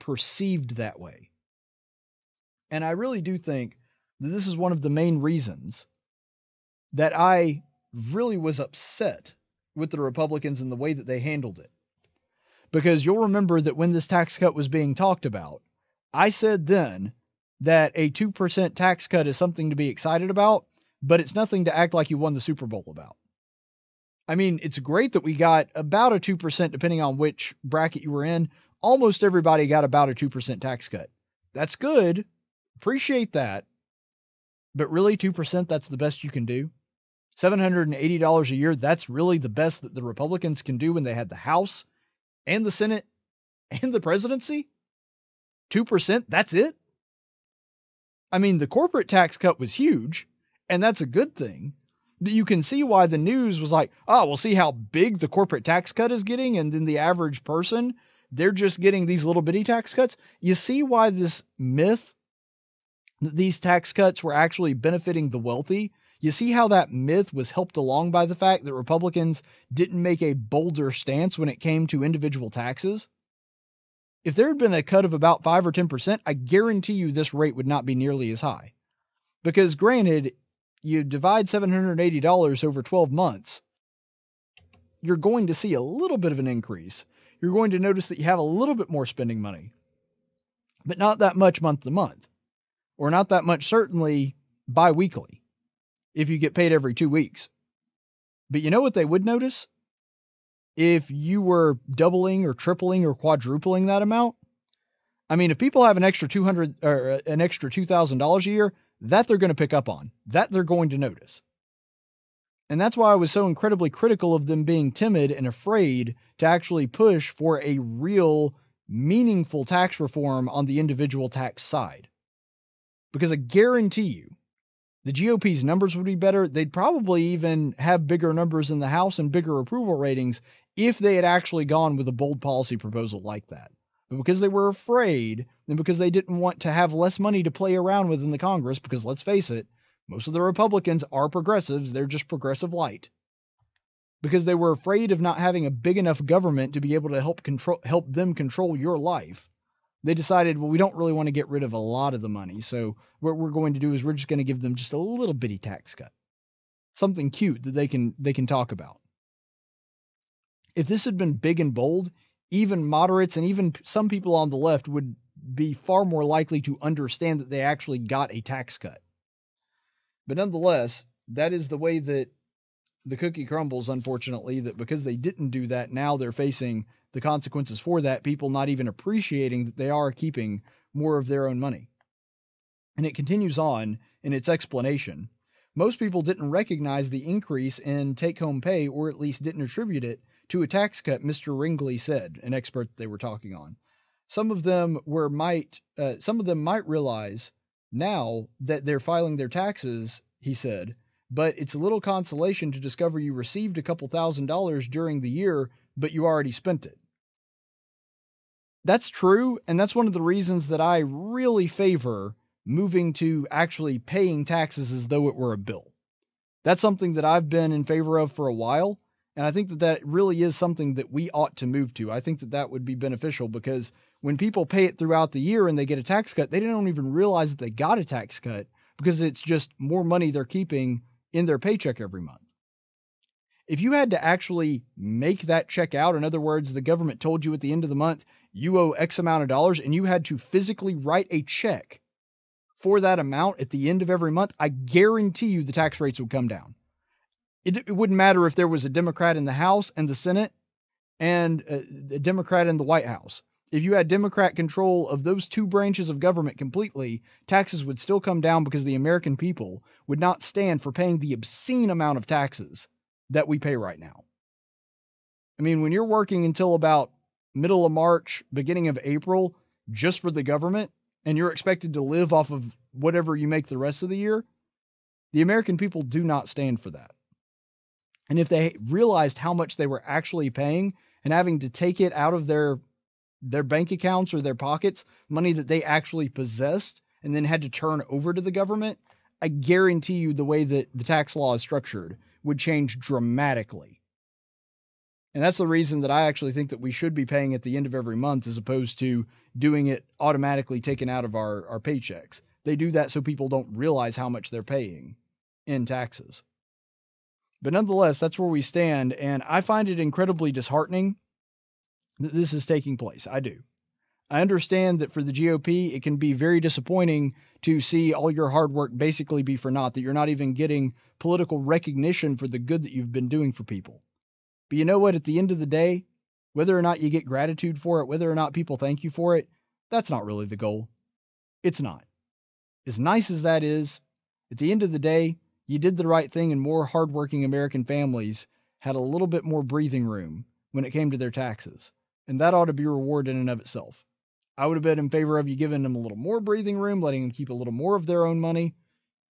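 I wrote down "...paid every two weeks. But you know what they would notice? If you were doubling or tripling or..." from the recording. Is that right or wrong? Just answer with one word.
right.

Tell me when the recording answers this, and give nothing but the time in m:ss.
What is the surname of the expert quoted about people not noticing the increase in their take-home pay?
3:11.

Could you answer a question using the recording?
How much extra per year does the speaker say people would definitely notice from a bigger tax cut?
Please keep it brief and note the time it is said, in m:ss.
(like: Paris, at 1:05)
$2,000, at 1:47.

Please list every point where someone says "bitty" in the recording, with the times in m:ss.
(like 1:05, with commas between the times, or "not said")
0:59, 2:35.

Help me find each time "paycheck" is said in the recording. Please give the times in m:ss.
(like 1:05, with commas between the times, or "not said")
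3:51, 5:01.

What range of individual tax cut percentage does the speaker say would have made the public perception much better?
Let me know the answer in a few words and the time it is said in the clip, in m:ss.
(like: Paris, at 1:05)
5 or 10%, at 1:15.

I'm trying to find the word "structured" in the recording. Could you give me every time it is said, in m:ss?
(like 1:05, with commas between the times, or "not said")
4:51.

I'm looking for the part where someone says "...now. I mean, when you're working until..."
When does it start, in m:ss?
4:23.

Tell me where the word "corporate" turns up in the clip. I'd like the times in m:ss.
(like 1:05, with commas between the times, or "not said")
0:48, 0:55.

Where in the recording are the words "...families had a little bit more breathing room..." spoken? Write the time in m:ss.
5:37.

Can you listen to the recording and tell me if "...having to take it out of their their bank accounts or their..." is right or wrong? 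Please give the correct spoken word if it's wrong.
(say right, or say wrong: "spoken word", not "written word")
right.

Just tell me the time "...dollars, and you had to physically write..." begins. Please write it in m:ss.
3:59.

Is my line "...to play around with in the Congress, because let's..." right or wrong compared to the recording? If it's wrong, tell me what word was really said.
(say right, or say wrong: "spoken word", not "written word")
right.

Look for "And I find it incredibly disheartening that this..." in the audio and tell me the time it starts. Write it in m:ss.
5:09.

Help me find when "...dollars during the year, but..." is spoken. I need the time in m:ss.
3:24.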